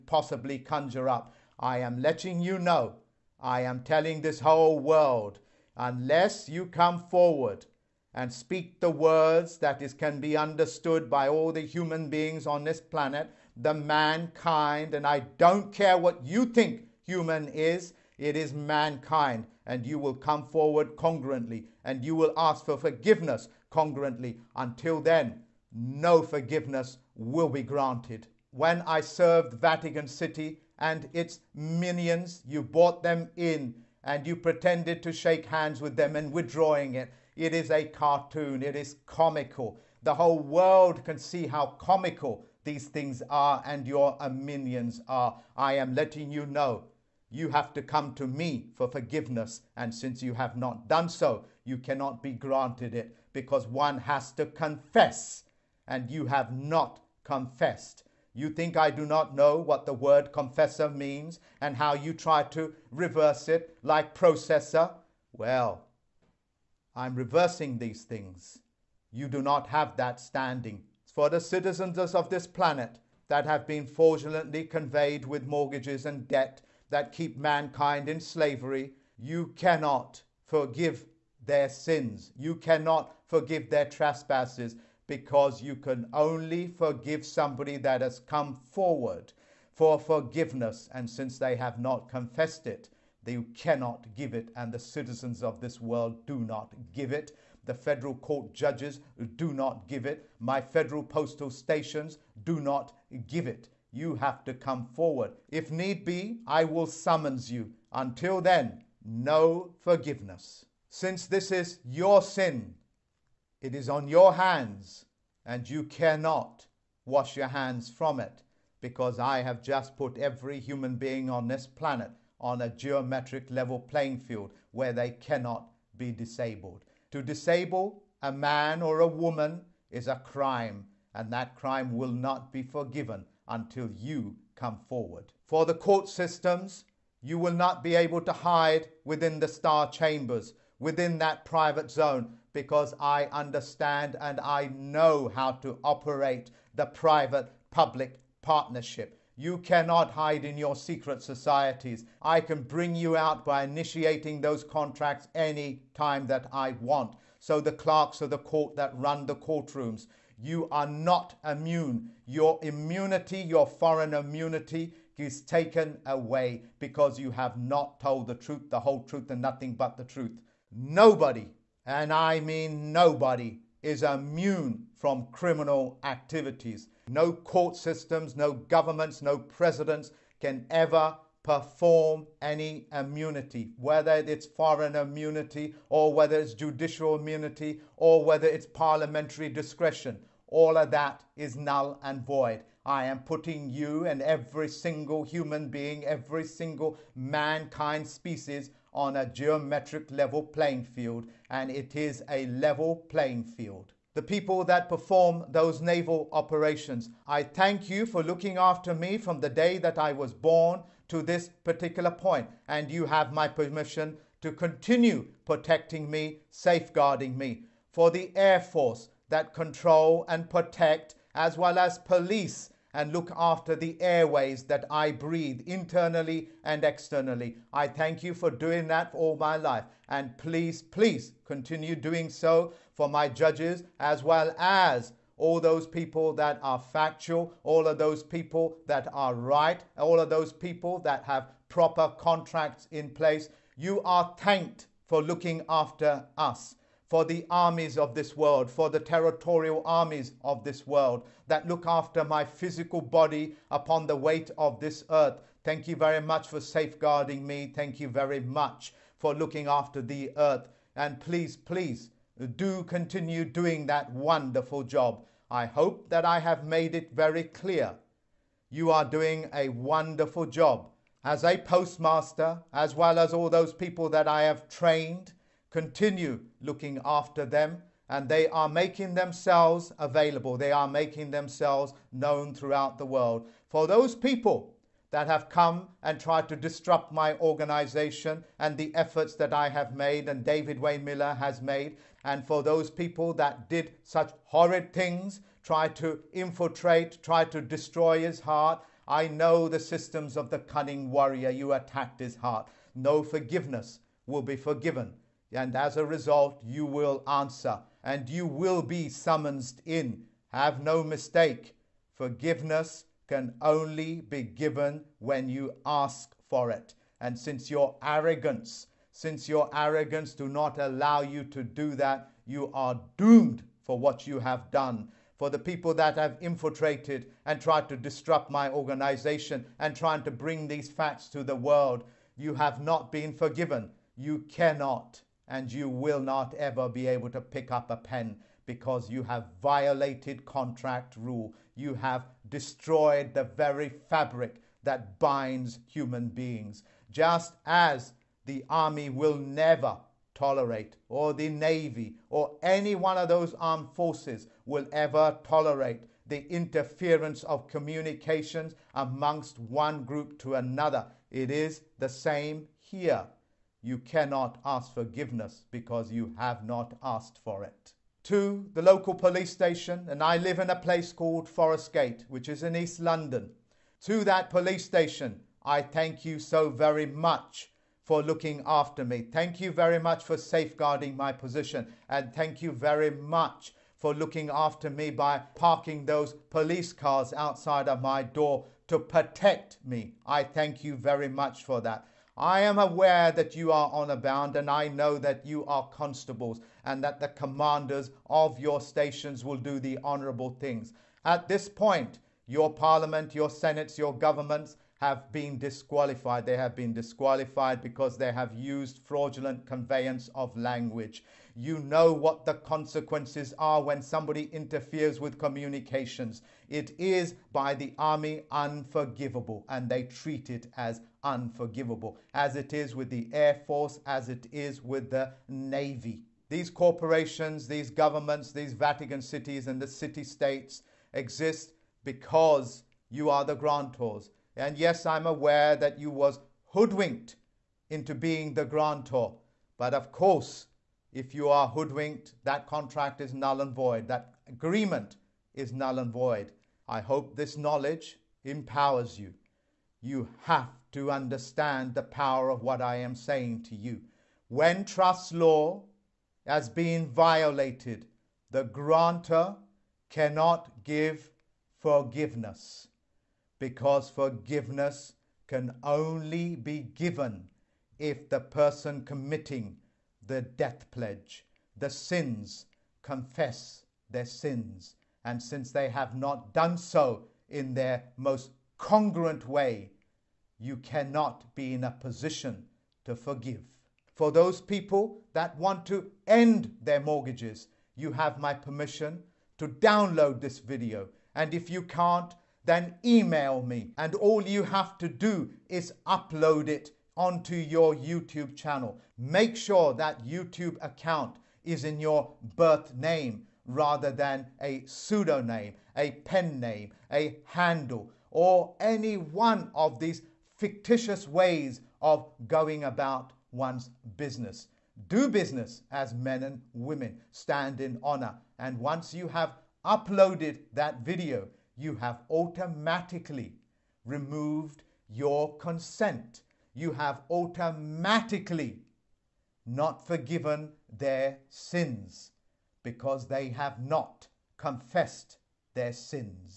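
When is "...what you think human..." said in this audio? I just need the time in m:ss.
0:15.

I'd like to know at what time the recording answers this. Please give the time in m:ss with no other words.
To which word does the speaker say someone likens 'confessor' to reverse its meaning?
1:04.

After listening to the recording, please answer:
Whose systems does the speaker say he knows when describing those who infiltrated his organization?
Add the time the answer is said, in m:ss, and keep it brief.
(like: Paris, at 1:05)
cunning warrior, at 5:00.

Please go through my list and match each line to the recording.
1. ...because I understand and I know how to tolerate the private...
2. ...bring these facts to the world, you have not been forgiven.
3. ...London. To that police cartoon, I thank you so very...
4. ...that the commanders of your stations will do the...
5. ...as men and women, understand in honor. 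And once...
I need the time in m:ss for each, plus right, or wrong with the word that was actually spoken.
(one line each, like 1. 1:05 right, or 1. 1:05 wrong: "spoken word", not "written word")
1. 2:22 wrong: "operate", not "tolerate"
2. 5:30 right
3. 6:12 wrong: "station", not "cartoon"
4. 6:37 right
5. 8:35 wrong: "stand", not "understand".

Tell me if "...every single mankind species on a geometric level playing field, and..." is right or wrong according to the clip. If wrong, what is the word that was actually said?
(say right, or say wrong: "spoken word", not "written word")
right.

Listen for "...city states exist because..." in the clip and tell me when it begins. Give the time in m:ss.
7:09.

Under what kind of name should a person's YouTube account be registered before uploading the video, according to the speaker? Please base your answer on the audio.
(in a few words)
birth name.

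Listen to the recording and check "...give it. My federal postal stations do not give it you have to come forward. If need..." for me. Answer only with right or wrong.
right.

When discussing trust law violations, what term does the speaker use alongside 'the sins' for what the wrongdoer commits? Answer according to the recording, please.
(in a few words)
death pledge.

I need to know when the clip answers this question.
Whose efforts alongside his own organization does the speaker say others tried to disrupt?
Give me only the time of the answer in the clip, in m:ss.
4:50.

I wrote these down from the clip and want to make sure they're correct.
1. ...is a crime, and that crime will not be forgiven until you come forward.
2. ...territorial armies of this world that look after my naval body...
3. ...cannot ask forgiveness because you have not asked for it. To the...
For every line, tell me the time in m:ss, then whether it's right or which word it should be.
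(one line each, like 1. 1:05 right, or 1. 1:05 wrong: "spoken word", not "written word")
1. 2:09 right
2. 4:08 wrong: "physical", not "naval"
3. 6:03 right.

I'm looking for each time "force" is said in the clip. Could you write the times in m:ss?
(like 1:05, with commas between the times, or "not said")
3:38, 5:53, 7:03.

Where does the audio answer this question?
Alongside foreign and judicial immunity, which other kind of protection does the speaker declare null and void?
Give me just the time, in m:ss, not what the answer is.
3:08.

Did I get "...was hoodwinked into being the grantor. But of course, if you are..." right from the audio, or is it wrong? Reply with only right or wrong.
right.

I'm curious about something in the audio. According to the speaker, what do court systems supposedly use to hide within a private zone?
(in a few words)
star chambers.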